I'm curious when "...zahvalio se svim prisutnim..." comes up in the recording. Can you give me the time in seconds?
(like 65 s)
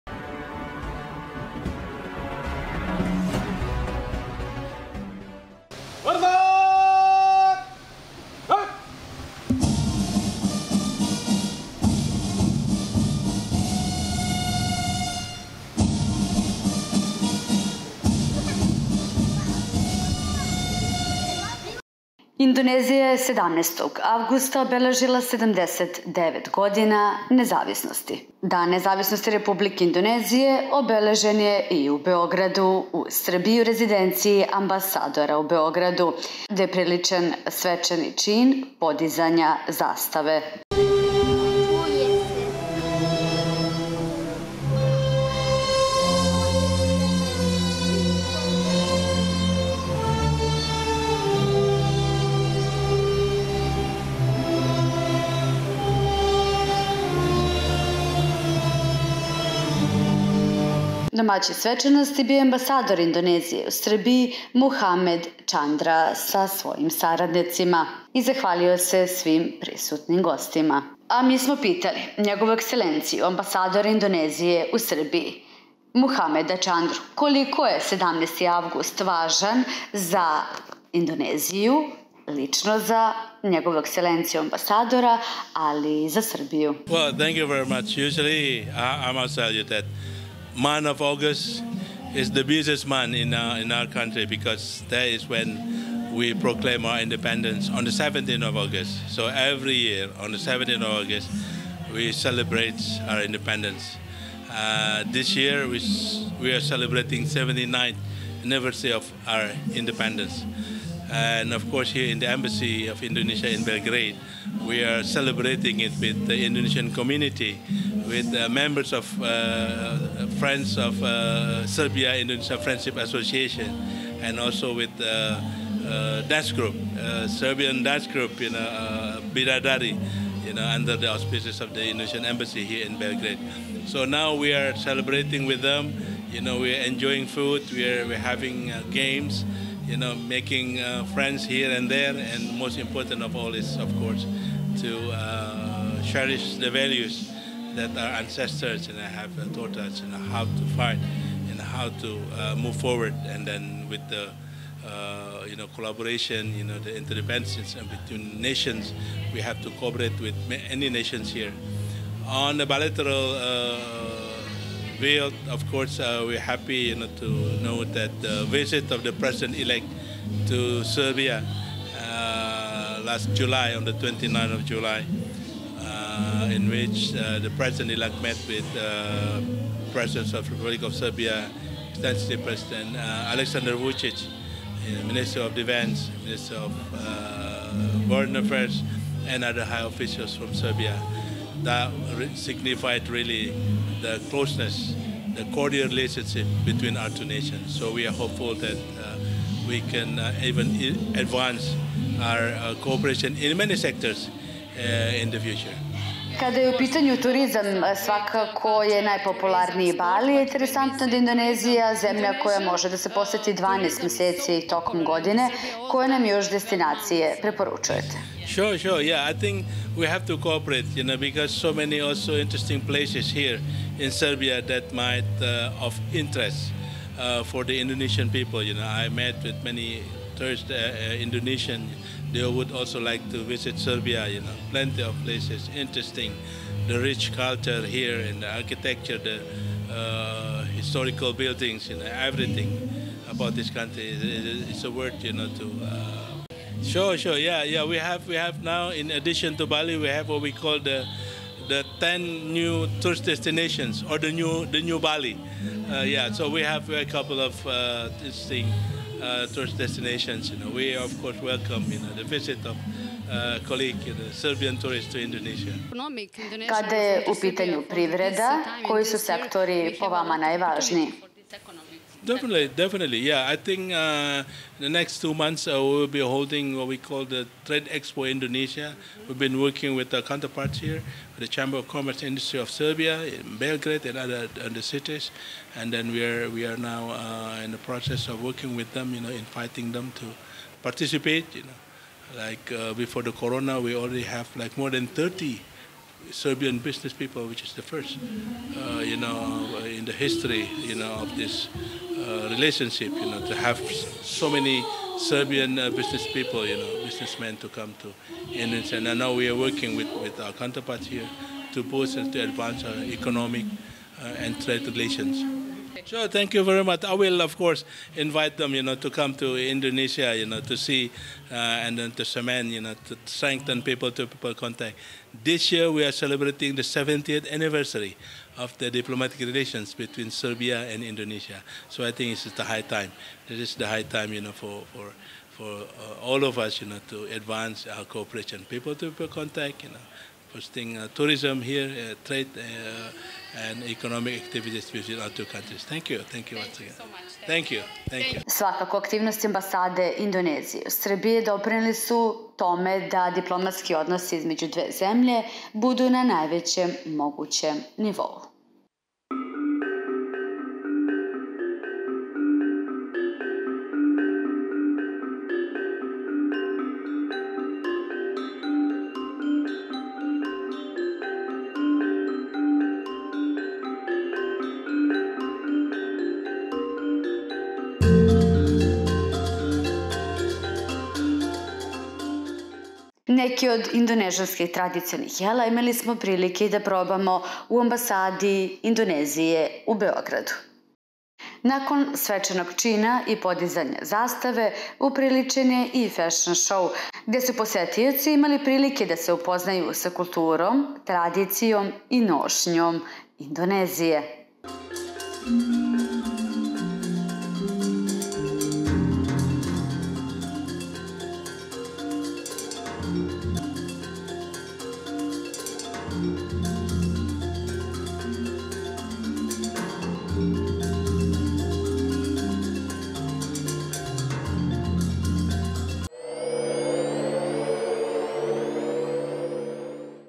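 68 s.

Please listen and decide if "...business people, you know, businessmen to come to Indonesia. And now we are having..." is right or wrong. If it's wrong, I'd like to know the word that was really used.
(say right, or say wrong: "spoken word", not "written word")
wrong: "working", not "having".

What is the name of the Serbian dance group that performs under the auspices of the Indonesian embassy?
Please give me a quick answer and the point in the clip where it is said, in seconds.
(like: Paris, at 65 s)
Biradari, at 129 s.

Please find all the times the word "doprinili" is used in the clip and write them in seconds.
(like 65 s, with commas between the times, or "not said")
351 s.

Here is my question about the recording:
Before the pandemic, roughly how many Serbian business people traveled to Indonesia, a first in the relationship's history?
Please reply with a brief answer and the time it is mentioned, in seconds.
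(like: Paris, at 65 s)
more than 30, at 294 s.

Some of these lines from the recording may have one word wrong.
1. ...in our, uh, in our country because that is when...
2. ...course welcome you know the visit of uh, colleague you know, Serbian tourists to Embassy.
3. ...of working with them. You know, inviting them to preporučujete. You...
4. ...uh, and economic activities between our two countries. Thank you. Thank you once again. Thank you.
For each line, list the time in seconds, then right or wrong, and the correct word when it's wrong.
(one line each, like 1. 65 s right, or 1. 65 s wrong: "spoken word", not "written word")
1. 93 s right
2. 261 s wrong: "Indonesia", not "Embassy"
3. 288 s wrong: "participate", not "preporučujete"
4. 342 s right.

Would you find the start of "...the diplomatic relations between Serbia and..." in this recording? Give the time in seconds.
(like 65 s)
328 s.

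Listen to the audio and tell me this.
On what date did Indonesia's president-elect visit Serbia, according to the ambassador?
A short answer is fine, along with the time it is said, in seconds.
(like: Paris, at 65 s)
29 July, at 173 s.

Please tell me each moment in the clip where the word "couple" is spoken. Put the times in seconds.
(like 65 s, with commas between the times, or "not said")
257 s.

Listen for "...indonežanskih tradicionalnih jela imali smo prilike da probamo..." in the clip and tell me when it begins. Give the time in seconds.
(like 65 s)
383 s.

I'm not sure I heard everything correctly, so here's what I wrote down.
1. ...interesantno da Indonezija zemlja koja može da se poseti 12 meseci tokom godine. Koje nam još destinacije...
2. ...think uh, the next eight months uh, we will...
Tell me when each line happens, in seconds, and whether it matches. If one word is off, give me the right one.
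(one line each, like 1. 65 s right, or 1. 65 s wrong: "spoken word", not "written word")
1. 210 s right
2. 273 s wrong: "two", not "eight".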